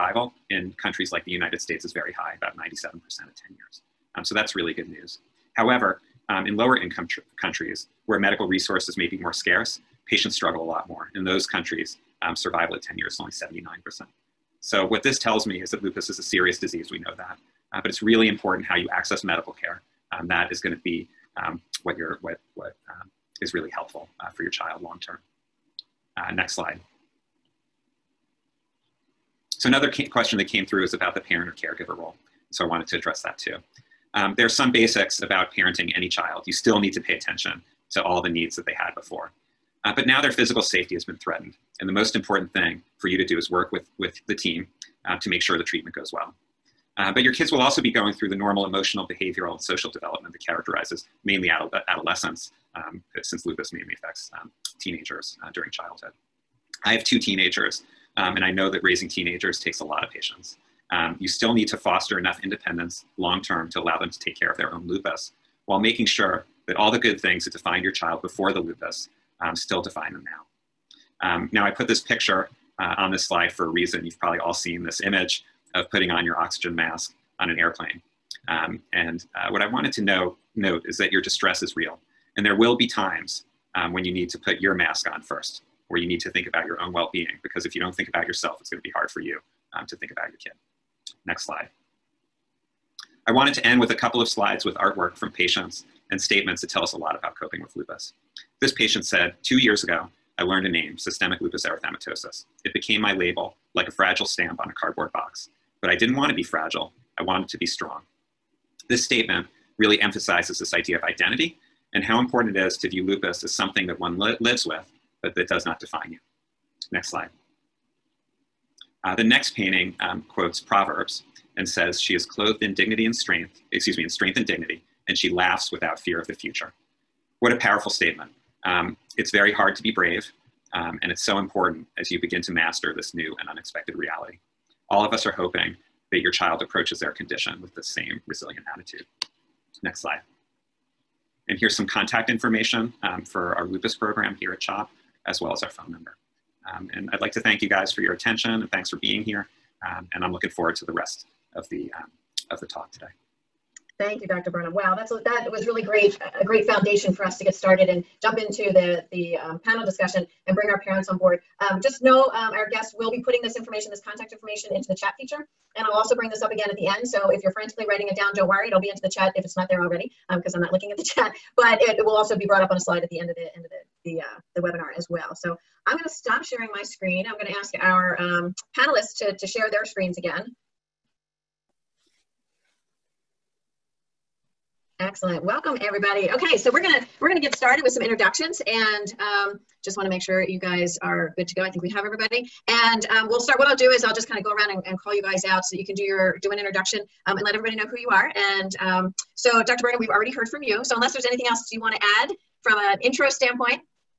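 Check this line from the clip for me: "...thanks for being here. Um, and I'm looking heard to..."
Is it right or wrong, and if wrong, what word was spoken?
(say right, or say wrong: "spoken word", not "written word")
wrong: "forward", not "heard".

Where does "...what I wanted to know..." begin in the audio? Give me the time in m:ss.
1:19.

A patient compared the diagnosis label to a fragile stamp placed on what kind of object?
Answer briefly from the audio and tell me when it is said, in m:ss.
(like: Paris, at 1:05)
Cardboard box, at 1:44.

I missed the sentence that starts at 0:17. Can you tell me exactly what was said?
Uh, but it's really important how you access medical care.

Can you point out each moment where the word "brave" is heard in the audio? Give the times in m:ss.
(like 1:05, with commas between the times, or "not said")
2:09.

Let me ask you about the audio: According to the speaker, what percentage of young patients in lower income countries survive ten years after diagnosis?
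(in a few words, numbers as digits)
79%.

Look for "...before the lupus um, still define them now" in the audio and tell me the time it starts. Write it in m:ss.
1:08.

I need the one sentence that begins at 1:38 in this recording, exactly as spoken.
This patient said, two years ago, I learned a name, systemic lupus erythematosus.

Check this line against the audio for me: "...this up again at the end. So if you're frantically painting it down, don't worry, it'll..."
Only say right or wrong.
wrong.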